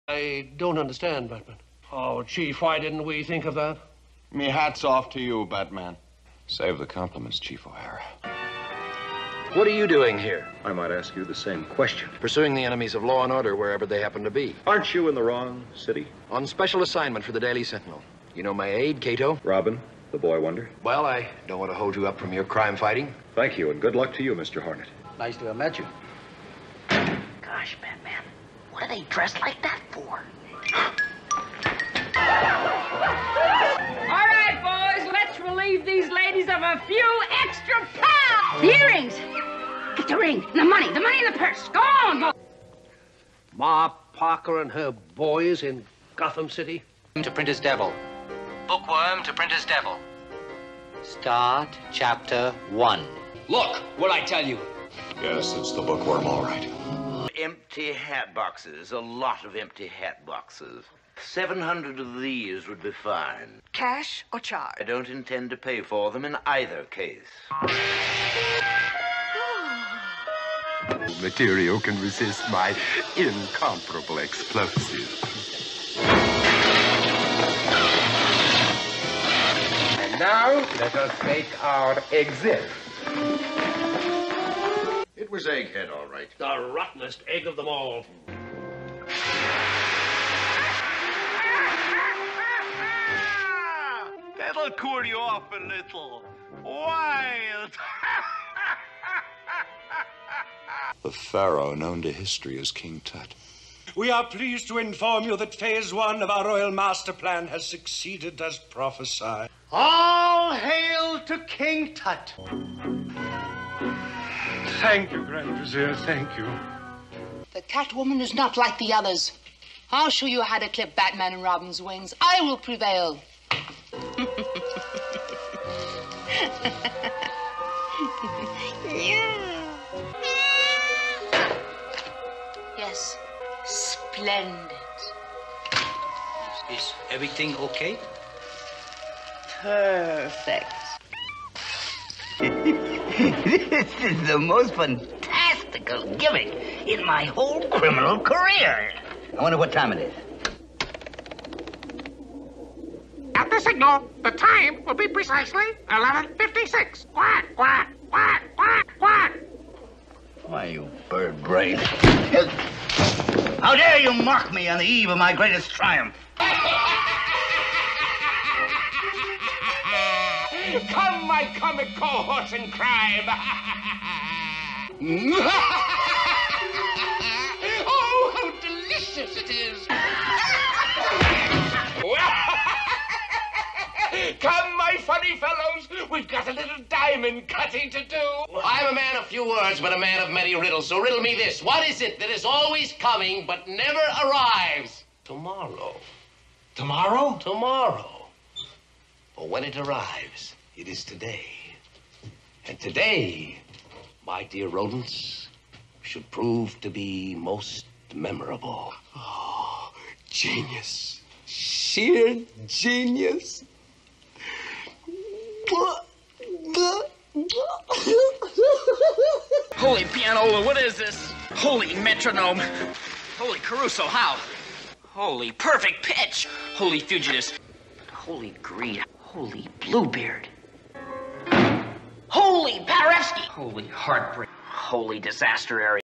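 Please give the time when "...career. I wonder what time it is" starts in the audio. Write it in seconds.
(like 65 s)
148 s.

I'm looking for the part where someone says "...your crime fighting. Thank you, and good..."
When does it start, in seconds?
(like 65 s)
22 s.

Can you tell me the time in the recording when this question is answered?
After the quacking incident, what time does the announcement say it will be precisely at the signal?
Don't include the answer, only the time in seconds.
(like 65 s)
155 s.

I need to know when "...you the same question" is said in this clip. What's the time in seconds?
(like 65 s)
11 s.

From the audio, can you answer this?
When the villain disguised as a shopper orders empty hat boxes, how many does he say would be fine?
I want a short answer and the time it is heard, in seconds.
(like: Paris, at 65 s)
700, at 61 s.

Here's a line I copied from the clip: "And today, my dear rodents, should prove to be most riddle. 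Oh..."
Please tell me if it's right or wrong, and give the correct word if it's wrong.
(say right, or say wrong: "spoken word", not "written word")
wrong: "memorable", not "riddle".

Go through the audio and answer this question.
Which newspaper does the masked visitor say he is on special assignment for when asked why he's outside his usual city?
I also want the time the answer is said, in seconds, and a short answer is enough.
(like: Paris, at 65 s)
Daily Sentinel, at 17 s.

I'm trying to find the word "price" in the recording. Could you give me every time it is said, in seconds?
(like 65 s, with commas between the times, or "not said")
not said.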